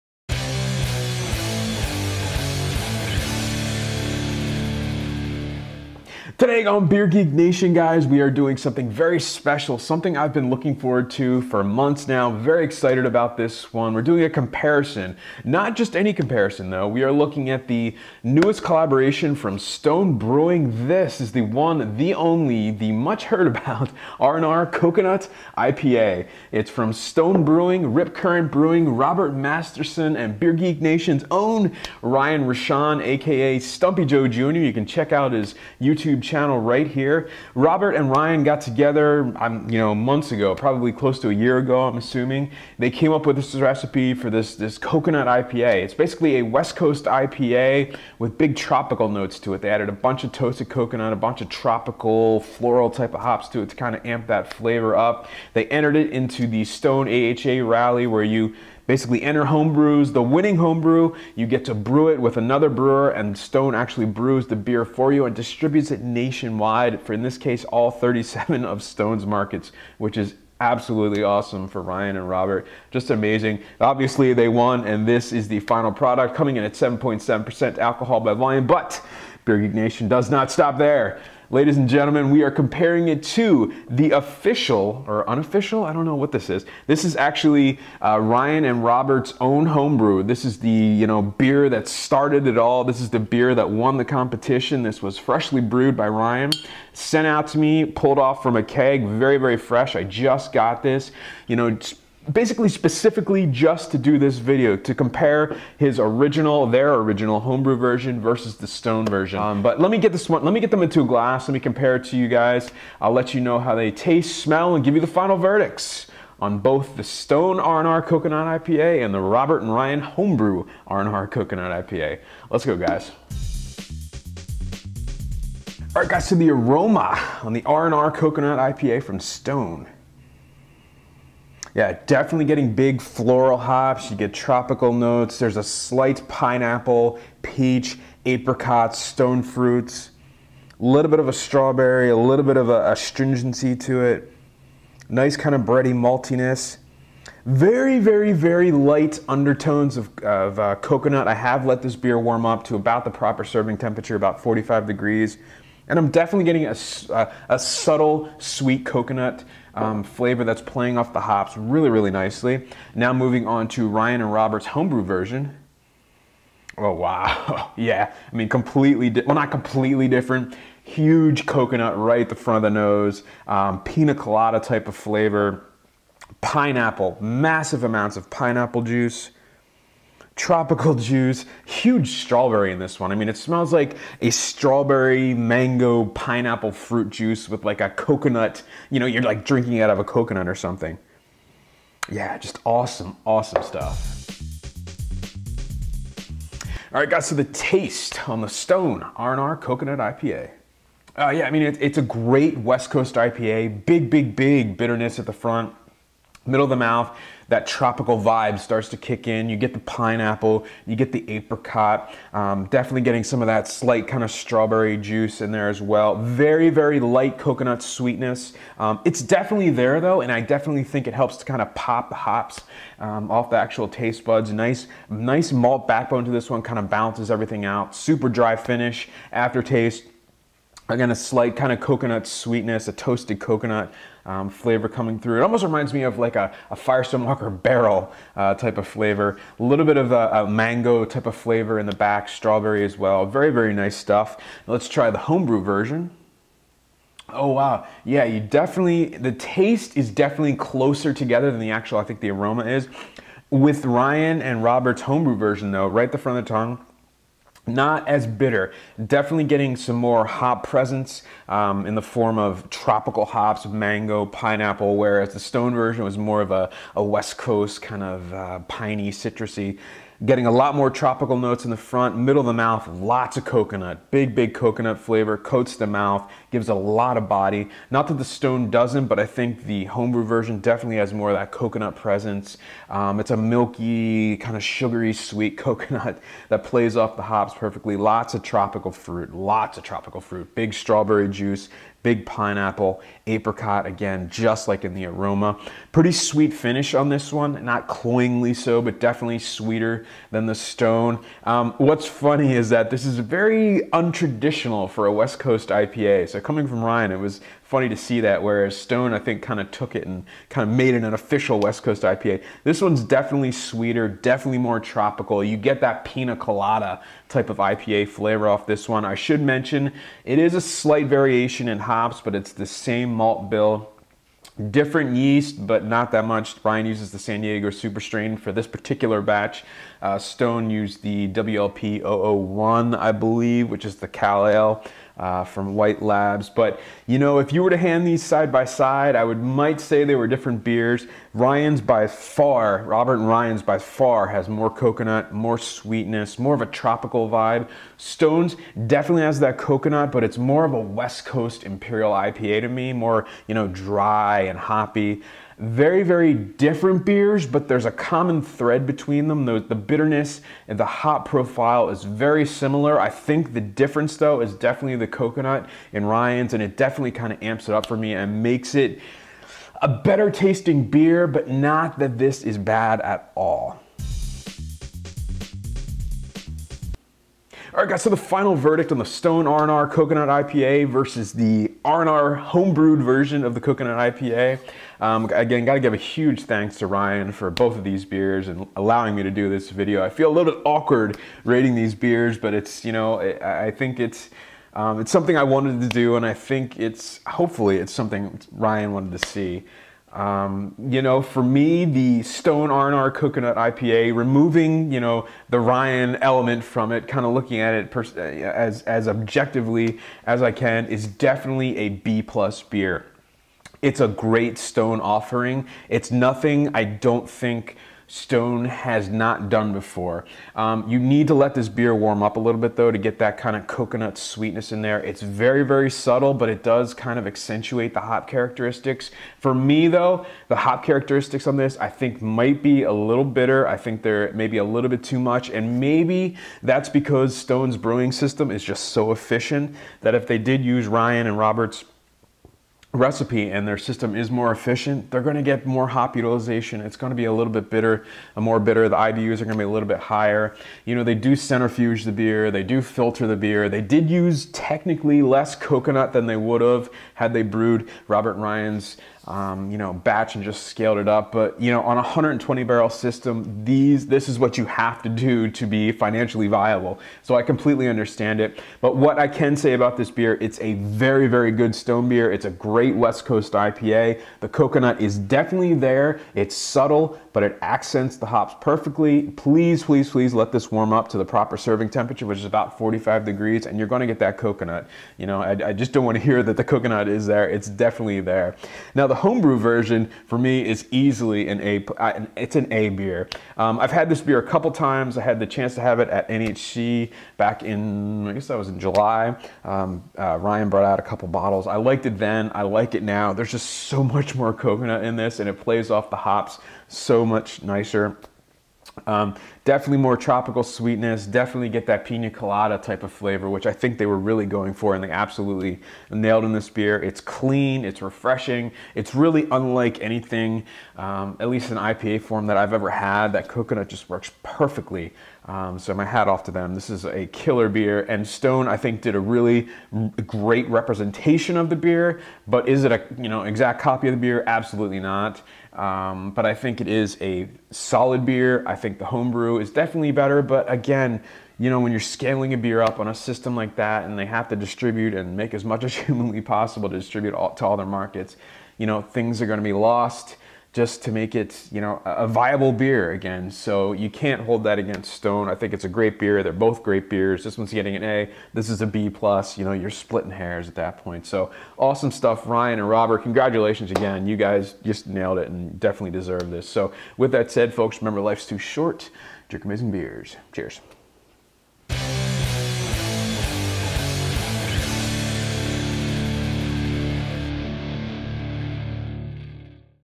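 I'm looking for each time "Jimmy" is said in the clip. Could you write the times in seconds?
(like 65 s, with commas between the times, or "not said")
not said.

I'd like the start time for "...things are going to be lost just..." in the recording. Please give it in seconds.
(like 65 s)
549 s.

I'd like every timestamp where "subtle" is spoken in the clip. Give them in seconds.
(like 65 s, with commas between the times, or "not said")
157 s, 425 s, 476 s.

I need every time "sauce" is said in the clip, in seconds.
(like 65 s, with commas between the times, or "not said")
not said.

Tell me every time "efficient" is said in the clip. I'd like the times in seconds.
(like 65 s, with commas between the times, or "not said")
439 s, 444 s.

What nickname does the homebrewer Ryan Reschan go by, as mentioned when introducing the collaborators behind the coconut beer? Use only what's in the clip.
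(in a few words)
Stumpy Joe Jr.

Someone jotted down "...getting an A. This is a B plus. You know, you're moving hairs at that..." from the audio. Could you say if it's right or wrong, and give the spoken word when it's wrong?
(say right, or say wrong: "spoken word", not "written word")
wrong: "splitting", not "moving".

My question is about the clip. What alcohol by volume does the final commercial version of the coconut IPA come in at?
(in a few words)
7.7%.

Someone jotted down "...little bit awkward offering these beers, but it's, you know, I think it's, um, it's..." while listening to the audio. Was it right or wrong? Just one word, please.
wrong.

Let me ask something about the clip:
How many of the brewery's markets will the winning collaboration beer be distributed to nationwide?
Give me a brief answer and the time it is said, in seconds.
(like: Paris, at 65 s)
37, at 67 s.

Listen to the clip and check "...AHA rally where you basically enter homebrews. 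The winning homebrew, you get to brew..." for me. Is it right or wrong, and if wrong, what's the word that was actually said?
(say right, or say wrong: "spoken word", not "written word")
right.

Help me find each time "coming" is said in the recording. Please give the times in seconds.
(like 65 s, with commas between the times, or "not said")
76 s, 234 s, 306 s.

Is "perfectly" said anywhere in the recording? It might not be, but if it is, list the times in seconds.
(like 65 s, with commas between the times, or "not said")
287 s, 478 s, 524 s.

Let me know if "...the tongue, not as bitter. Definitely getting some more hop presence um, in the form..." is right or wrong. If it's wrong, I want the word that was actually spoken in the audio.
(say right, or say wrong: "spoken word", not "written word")
right.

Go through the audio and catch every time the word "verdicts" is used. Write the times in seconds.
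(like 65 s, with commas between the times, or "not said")
115 s, 378 s.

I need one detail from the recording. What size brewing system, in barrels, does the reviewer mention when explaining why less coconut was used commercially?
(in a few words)
120 barrels.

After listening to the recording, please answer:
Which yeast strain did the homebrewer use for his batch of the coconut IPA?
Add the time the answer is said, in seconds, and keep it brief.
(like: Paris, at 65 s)
San Diego Super Strain, at 327 s.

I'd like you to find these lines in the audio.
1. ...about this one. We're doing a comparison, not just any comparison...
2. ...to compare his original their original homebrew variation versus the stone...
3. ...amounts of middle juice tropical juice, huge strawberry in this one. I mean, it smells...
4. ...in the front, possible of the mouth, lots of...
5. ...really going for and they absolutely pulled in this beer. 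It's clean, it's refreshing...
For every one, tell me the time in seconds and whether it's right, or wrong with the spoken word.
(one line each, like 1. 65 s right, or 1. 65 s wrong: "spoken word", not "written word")
1. 13 s right
2. 104 s wrong: "version", not "variation"
3. 177 s wrong: "pineapple", not "middle"
4. 271 s wrong: "middle", not "possible"
5. 514 s wrong: "nailed", not "pulled".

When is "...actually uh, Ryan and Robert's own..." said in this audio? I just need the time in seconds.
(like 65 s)
87 s.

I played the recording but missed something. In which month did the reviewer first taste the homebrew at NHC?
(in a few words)
July.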